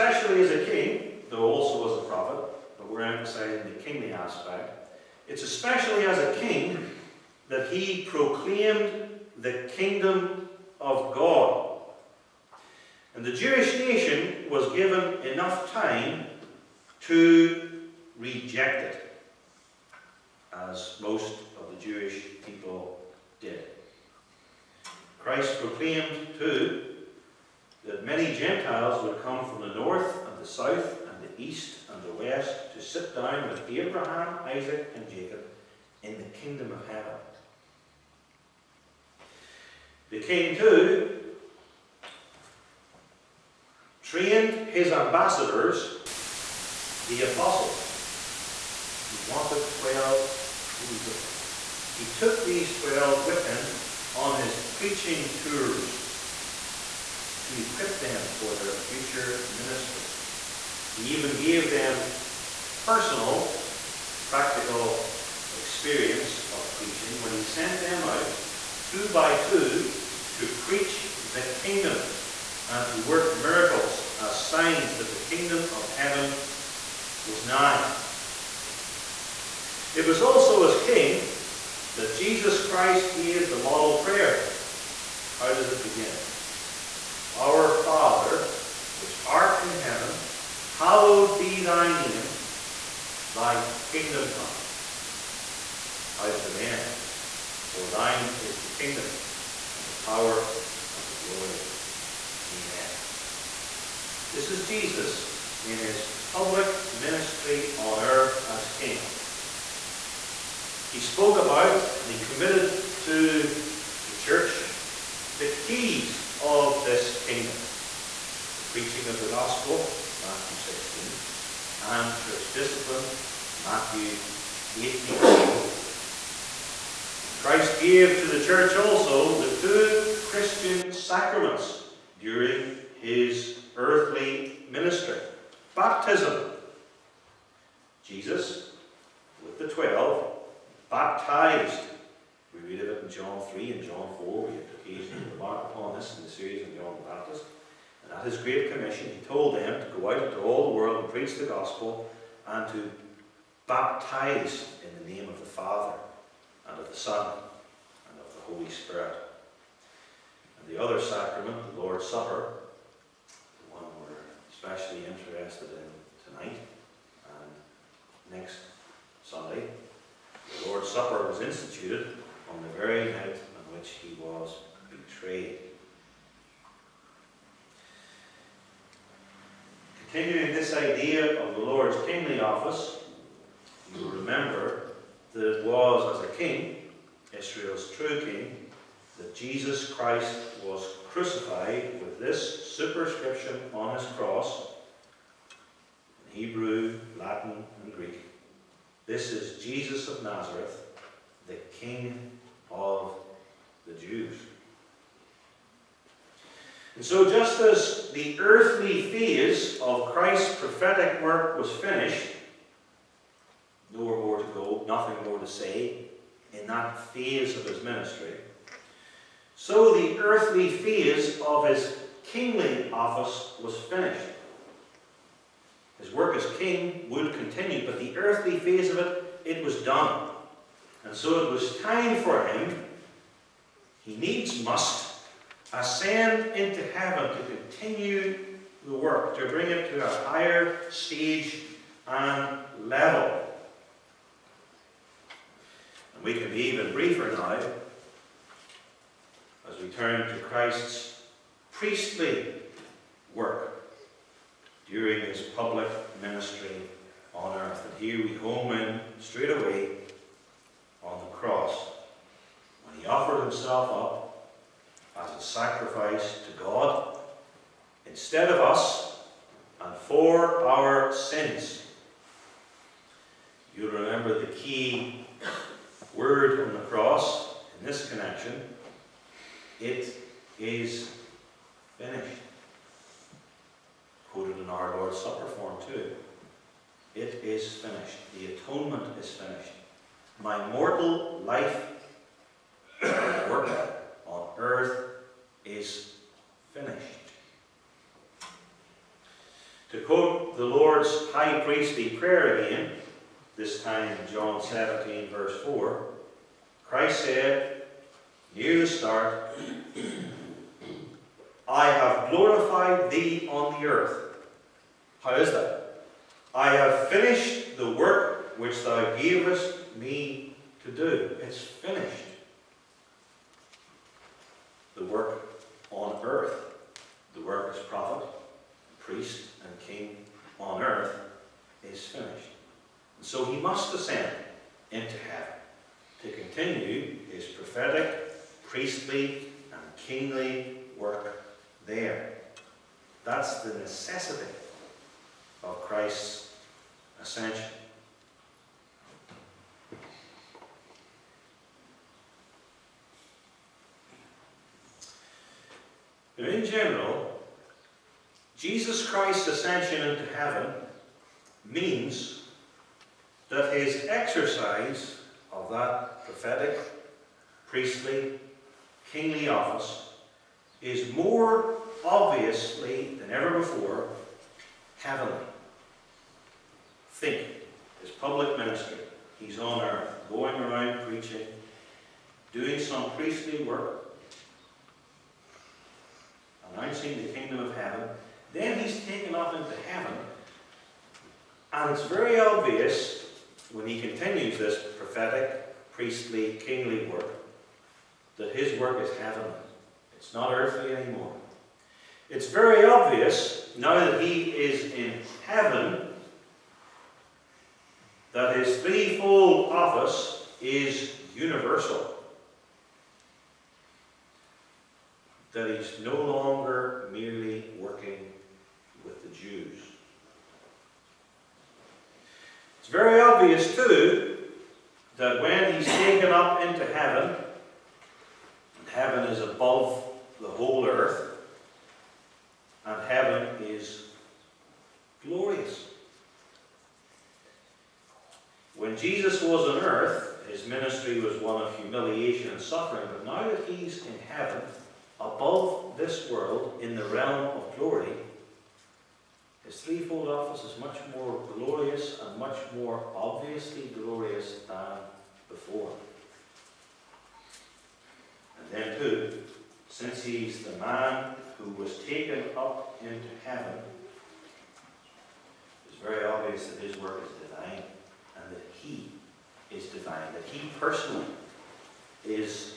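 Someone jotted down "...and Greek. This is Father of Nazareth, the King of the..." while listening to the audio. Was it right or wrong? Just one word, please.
wrong.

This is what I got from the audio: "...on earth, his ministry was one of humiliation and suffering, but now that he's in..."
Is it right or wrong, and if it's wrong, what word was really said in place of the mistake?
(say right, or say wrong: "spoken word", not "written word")
right.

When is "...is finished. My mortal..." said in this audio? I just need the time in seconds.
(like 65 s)
289 s.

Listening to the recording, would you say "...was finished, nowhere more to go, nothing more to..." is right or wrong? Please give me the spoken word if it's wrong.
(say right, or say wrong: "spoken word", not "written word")
right.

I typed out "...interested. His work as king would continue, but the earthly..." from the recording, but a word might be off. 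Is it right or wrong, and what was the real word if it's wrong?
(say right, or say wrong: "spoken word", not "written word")
wrong: "finished", not "interested".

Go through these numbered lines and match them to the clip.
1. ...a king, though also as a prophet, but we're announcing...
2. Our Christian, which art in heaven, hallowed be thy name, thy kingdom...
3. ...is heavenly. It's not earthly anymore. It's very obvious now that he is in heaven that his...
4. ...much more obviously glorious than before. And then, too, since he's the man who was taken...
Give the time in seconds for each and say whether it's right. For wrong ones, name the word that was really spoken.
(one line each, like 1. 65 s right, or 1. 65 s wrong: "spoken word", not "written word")
1. 0 s wrong: "emphasizing", not "announcing"
2. 87 s wrong: "Father", not "Christian"
3. 399 s right
4. 452 s right.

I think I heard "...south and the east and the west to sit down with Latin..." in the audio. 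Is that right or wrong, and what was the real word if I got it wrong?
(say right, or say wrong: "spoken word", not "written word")
wrong: "Abraham", not "Latin".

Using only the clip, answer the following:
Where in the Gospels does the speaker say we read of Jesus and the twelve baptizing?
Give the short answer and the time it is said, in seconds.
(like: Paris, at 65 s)
John 3 and John 4, at 143 s.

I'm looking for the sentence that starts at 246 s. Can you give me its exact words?
And we can be even briefer now as we turn to Christ's priestly work during his public ministry on earth.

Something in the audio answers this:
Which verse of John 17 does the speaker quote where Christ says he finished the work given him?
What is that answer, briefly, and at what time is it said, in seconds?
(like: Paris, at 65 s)
Verse 4, at 305 s.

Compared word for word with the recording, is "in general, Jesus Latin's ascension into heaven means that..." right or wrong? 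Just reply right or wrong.
wrong.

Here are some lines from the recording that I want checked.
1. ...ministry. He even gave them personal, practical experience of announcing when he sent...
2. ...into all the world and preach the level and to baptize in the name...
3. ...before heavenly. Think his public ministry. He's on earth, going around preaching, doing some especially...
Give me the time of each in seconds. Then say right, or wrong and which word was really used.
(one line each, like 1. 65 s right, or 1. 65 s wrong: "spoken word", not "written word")
1. 59 s wrong: "preaching", not "announcing"
2. 150 s wrong: "gospel", not "level"
3. 373 s wrong: "priestly", not "especially".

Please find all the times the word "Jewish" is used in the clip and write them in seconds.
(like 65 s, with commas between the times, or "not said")
13 s, 21 s.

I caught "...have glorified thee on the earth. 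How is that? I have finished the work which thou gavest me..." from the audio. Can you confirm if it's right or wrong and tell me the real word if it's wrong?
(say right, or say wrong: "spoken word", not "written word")
right.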